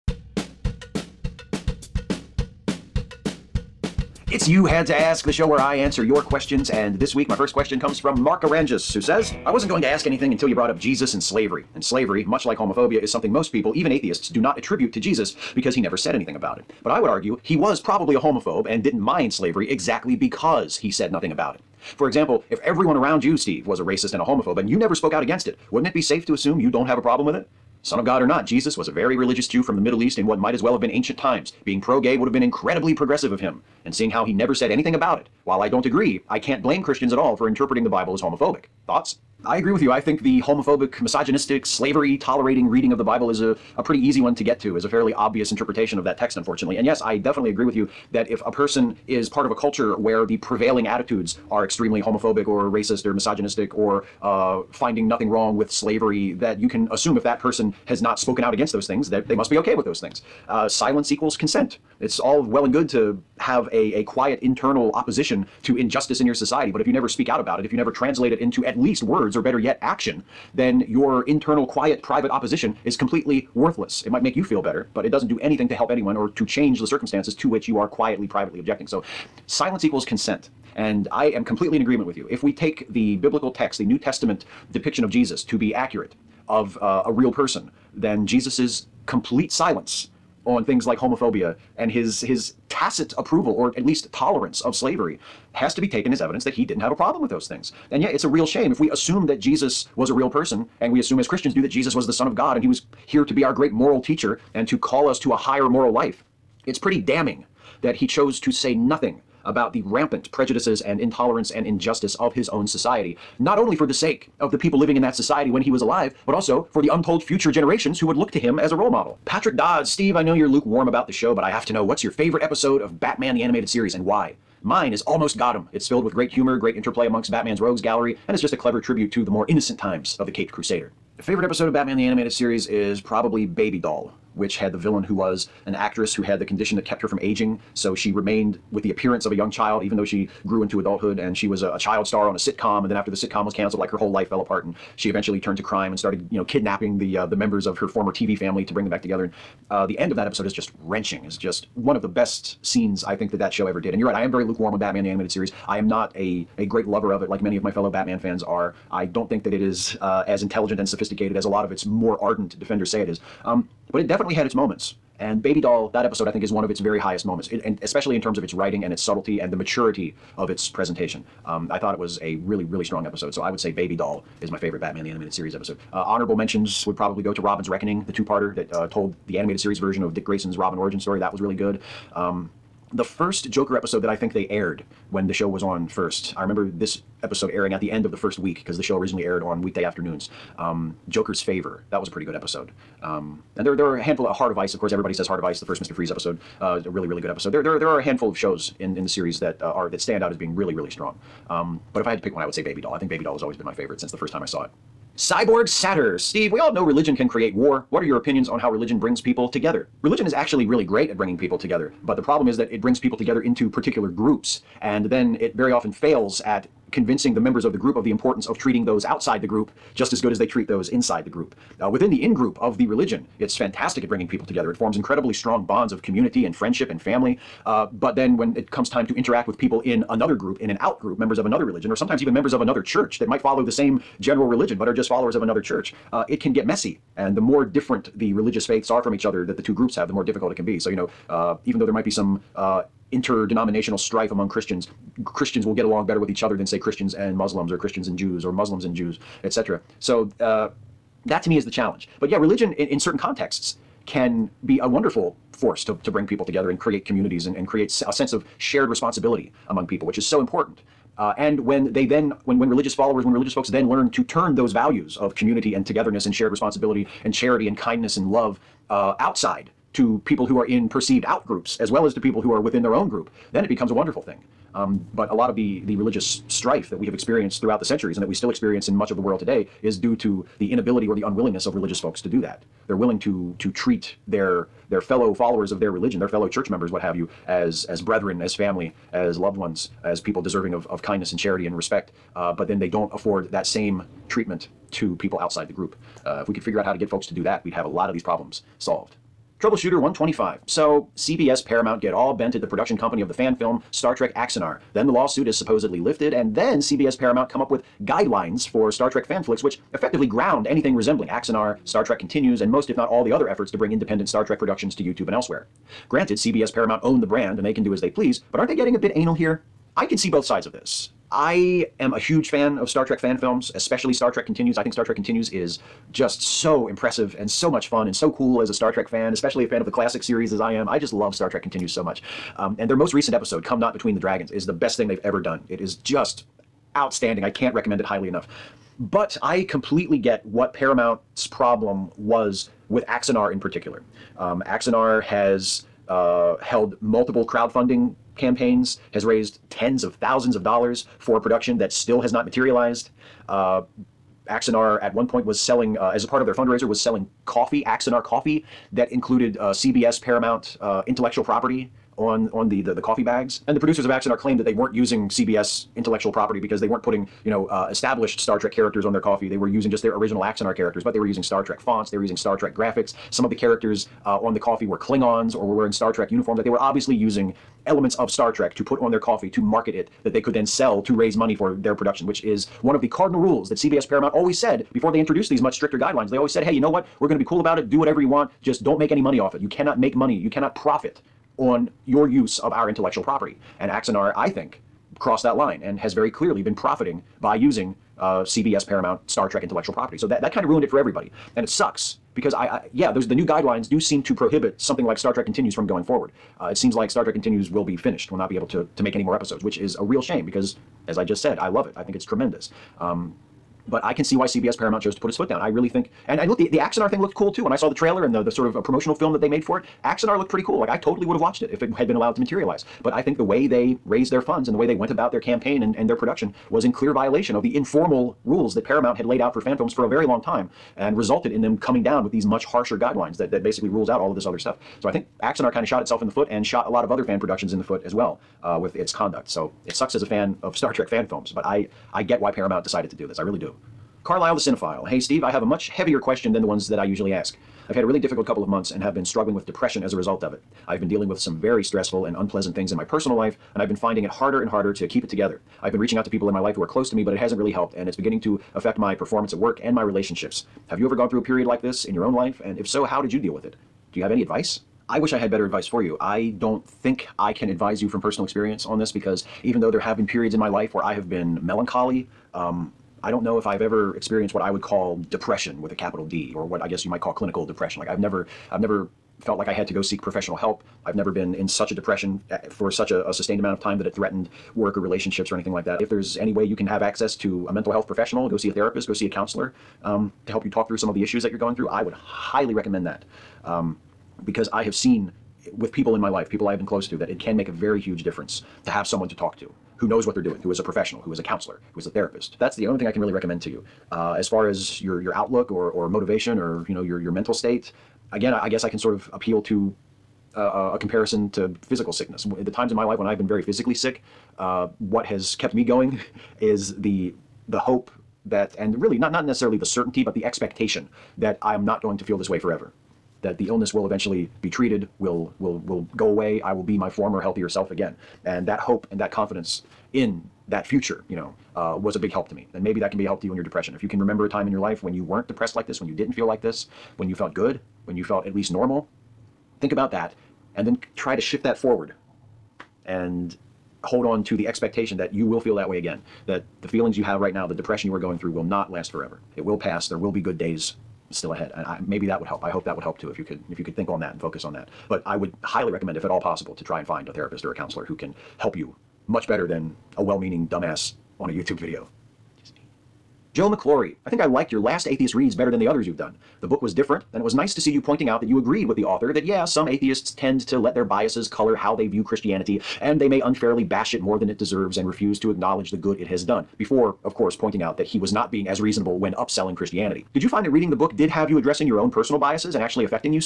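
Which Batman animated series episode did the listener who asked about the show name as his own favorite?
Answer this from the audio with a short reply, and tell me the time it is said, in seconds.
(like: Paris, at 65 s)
Almost Got 'Im, at 125 s.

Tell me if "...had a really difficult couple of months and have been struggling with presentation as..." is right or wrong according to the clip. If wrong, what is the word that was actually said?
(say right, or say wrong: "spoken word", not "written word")
wrong: "depression", not "presentation".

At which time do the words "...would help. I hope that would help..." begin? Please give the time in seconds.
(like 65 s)
552 s.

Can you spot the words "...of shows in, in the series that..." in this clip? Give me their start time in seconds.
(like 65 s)
198 s.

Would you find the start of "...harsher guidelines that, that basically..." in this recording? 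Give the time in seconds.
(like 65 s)
432 s.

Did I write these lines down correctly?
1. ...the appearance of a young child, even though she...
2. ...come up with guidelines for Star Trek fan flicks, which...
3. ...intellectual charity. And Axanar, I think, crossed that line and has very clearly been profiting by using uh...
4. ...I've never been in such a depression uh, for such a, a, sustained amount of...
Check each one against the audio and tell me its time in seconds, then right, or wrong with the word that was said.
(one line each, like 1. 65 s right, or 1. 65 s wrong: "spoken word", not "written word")
1. 138 s right
2. 307 s right
3. 392 s wrong: "property", not "charity"
4. 481 s right.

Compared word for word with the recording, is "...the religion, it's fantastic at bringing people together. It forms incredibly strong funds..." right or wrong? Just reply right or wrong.
wrong.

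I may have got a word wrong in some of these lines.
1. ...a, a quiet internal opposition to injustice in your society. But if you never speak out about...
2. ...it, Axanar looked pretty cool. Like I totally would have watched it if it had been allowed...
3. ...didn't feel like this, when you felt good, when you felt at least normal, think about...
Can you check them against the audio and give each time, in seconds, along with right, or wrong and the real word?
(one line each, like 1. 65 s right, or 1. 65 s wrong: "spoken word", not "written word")
1. 63 s right
2. 419 s right
3. 536 s right.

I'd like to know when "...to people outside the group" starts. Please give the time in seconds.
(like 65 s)
294 s.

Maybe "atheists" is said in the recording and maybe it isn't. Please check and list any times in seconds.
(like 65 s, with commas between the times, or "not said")
13 s, 565 s, 569 s.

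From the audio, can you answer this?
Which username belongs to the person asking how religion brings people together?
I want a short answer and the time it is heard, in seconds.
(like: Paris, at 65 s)
Cyborg Satter, at 205 s.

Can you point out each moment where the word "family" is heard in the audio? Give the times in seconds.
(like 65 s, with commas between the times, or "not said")
148 s, 227 s, 288 s.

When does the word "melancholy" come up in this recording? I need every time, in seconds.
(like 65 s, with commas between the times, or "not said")
471 s.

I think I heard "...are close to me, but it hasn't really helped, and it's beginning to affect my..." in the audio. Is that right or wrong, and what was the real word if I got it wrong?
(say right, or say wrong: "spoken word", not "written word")
right.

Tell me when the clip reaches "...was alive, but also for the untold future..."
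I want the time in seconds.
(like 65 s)
115 s.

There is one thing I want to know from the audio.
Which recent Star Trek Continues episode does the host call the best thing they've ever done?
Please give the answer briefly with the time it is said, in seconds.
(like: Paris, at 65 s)
Come Not Between the Dragons, at 333 s.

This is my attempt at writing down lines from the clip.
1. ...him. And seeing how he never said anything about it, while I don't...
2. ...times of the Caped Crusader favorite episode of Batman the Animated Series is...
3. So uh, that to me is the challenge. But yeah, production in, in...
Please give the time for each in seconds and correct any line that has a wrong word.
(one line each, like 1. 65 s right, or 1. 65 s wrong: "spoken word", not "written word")
1. 33 s right
2. 129 s right
3. 250 s wrong: "religion", not "production".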